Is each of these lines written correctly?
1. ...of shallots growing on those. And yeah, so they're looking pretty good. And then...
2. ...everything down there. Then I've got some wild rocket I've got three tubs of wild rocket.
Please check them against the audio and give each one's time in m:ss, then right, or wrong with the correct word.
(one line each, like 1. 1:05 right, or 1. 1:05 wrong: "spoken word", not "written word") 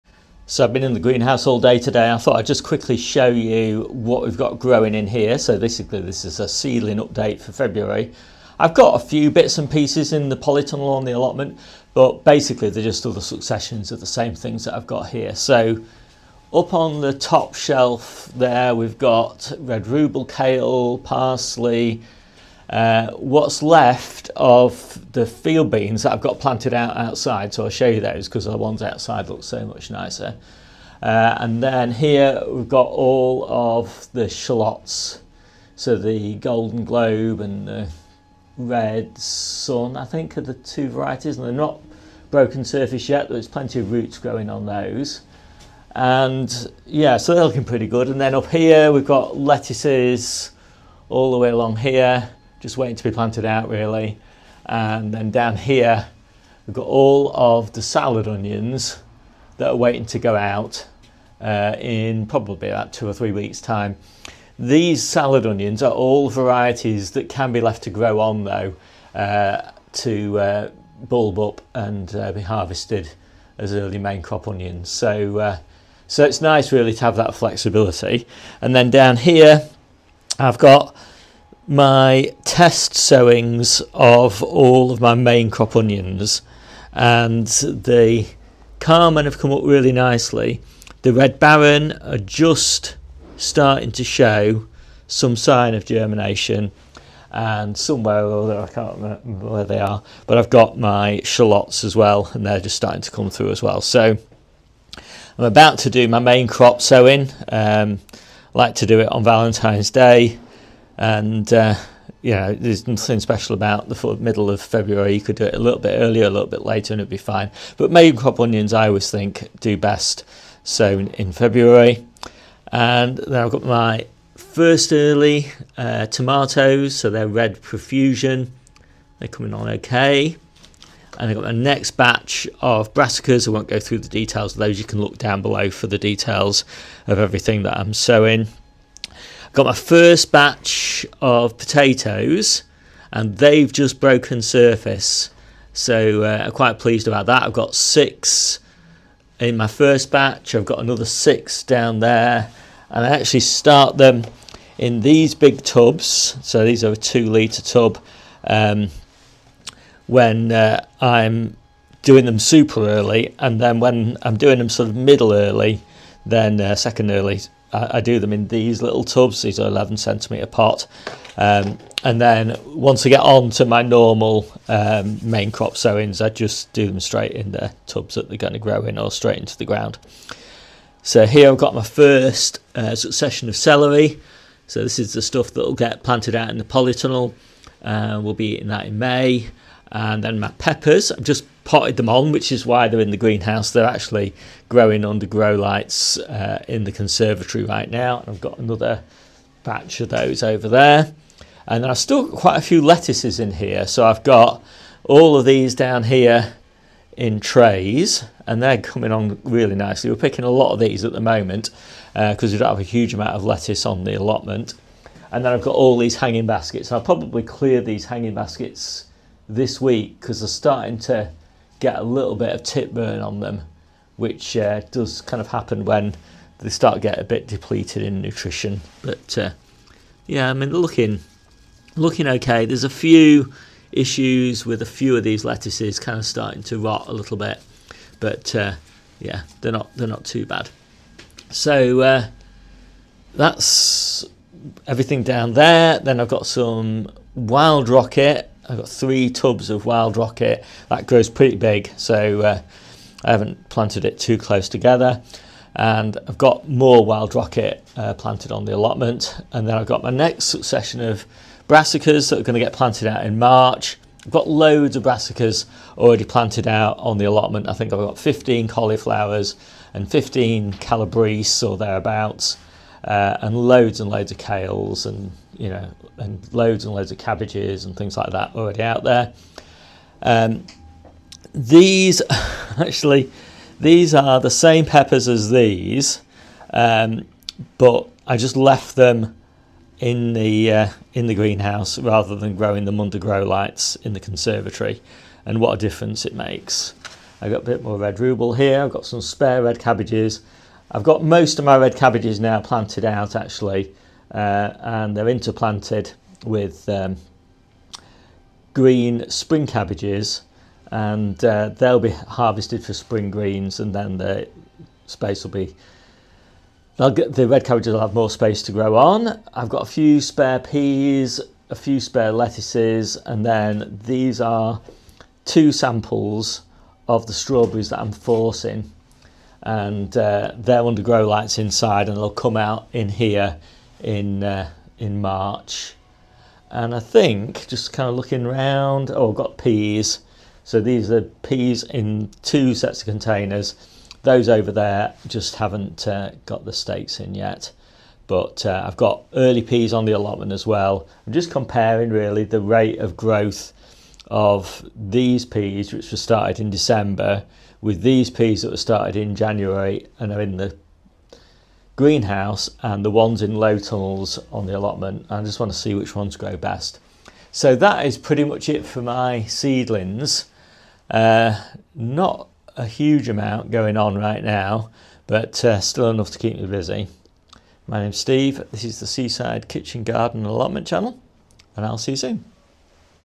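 1. 0:43 wrong: "roots", not "shallots"
2. 4:04 right.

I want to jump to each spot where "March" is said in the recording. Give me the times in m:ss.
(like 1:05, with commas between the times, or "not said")
4:23, 5:35.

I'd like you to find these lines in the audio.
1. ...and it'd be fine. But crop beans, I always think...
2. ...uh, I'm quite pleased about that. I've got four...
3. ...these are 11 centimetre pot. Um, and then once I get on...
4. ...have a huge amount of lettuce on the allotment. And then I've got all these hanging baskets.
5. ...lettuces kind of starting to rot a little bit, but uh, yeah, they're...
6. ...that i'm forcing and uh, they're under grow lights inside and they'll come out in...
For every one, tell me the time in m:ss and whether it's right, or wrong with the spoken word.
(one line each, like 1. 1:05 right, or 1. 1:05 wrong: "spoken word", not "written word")
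1. 1:56 wrong: "onions", not "beans"
2. 2:26 wrong: "six", not "four"
3. 2:49 right
4. 3:32 right
5. 3:55 right
6. 5:27 right.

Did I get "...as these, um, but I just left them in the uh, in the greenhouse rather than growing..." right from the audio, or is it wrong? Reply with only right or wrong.
right.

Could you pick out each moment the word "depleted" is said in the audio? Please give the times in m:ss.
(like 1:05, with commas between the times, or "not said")
3:47.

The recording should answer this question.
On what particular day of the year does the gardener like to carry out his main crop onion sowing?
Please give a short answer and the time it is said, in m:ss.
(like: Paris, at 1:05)
Valentine's Day, at 1:49.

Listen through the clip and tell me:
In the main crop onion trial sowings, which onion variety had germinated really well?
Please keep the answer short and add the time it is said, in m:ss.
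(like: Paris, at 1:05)
Karmen, at 1:28.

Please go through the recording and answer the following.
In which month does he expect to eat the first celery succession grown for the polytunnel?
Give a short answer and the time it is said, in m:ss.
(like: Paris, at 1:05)
May, at 3:08.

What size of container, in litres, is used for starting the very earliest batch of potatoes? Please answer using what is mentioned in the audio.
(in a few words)
2 litres.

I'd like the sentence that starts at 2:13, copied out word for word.
I won't go through the details of those.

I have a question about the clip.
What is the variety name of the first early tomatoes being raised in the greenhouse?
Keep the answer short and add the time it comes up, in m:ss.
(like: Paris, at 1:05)
Red Profusion, at 2:07.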